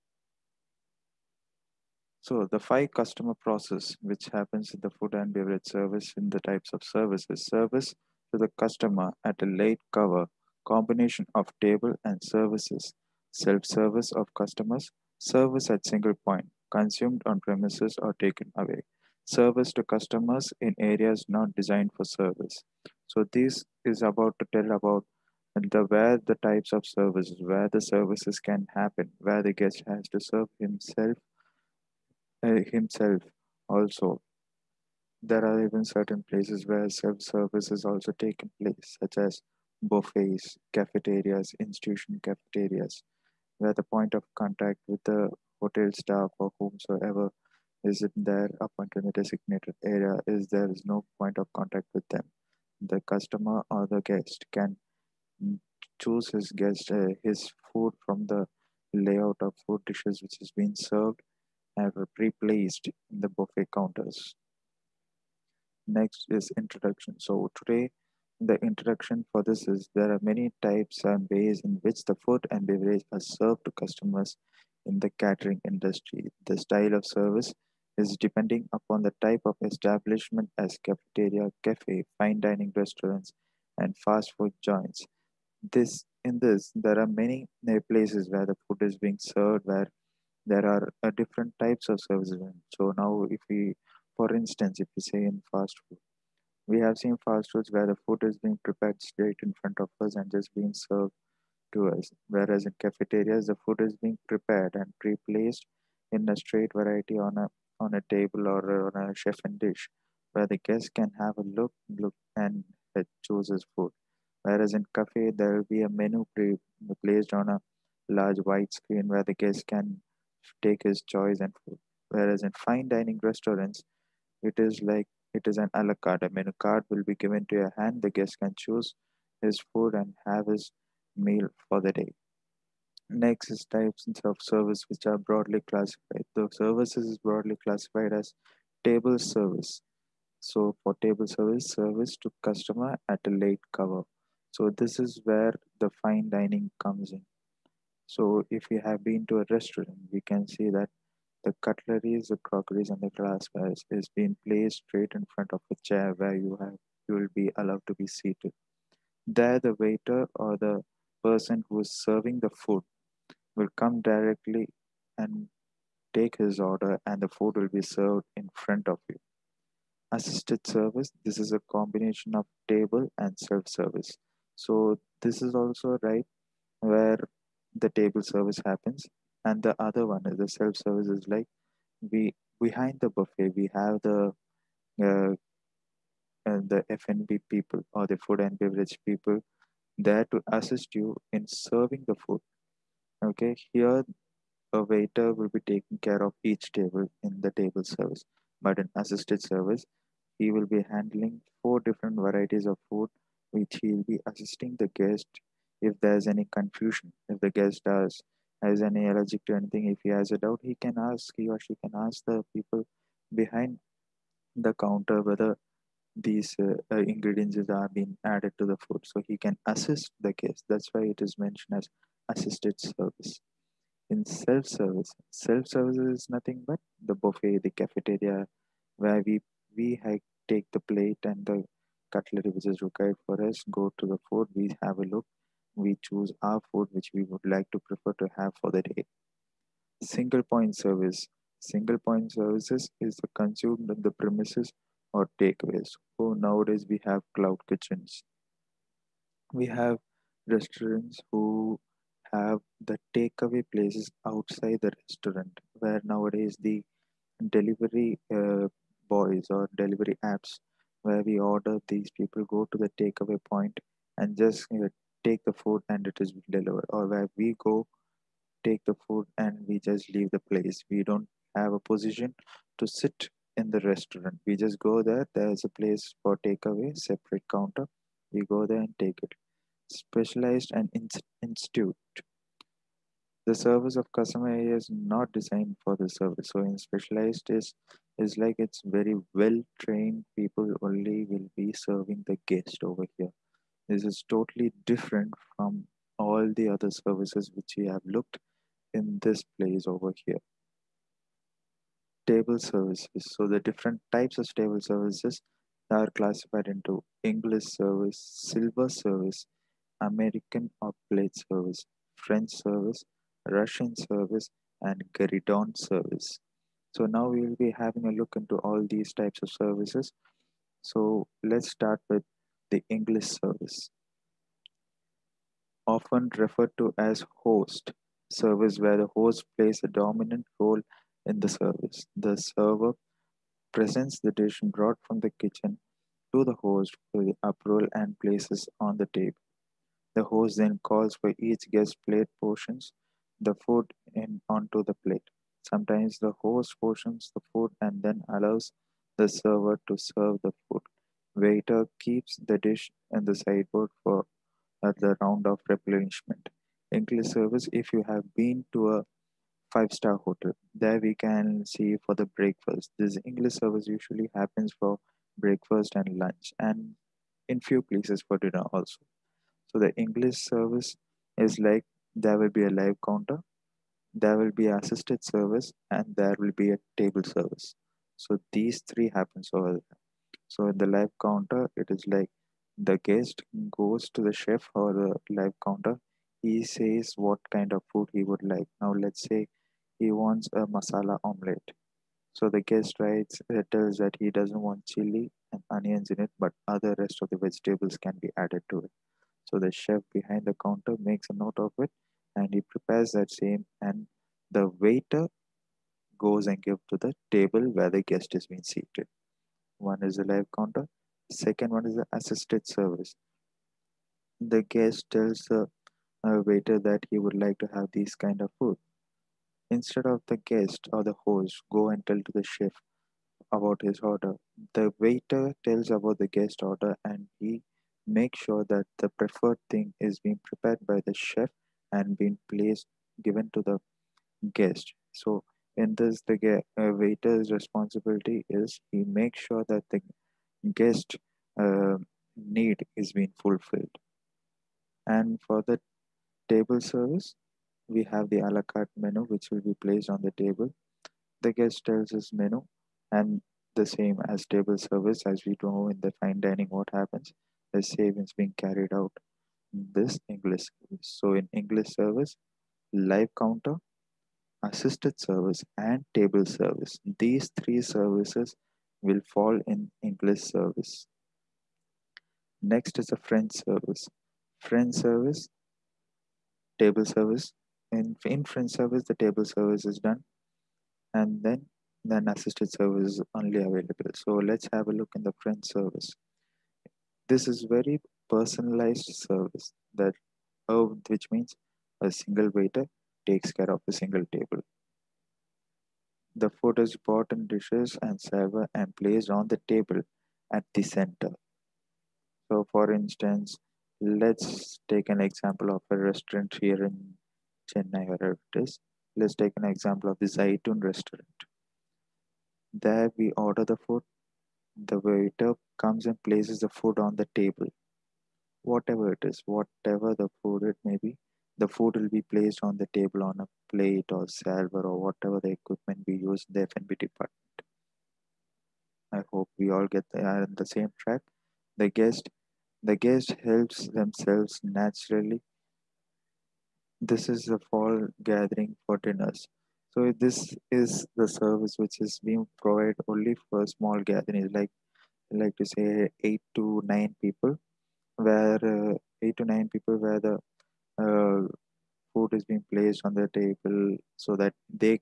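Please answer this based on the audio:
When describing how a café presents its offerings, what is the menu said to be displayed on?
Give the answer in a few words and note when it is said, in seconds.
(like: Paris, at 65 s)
large white screen, at 118 s.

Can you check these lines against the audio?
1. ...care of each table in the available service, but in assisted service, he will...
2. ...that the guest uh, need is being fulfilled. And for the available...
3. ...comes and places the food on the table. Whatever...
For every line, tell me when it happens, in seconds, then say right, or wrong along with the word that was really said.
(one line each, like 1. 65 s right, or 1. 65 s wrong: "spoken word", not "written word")
1. 196 s wrong: "table", not "available"
2. 439 s wrong: "table", not "available"
3. 515 s right.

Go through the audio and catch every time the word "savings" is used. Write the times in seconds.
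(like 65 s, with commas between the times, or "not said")
457 s.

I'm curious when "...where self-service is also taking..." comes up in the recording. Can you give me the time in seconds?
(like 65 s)
36 s.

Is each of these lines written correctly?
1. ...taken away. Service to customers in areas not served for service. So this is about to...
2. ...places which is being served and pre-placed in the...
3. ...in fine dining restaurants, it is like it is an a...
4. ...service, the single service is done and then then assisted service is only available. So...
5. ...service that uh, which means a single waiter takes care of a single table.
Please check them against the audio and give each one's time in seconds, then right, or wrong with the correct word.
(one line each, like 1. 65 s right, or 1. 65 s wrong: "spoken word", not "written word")
1. 18 s wrong: "designed", not "served"
2. 59 s wrong: "dishes", not "places"
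3. 122 s right
4. 478 s wrong: "table", not "single"
5. 489 s right.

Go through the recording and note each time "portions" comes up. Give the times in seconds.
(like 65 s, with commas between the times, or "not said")
342 s, 346 s.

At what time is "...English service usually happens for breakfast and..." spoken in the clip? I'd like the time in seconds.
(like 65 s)
363 s.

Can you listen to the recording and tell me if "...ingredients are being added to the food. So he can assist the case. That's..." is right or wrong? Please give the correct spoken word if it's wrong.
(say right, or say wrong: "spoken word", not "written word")
right.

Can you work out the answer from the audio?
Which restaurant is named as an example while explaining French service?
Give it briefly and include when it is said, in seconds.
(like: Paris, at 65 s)
Zaitun, at 510 s.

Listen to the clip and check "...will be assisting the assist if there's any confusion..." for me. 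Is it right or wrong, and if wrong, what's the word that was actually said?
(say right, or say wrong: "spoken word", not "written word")
wrong: "guest", not "assist".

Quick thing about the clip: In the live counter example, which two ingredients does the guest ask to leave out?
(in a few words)
chili and onions.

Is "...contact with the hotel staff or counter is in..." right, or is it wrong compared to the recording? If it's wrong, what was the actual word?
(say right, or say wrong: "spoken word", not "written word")
wrong: "whomsoever", not "counter".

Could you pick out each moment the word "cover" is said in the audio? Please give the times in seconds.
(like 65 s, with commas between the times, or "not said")
9 s, 143 s.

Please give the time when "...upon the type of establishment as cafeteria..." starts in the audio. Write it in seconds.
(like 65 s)
78 s.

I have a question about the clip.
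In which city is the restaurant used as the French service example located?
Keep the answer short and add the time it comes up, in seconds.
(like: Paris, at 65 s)
Chennai, at 507 s.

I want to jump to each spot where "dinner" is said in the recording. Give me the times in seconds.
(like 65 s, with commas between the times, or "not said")
368 s, 538 s.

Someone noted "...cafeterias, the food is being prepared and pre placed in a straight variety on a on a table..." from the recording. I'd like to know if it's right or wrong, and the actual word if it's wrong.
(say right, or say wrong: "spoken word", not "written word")
right.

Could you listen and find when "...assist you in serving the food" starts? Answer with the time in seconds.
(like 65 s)
190 s.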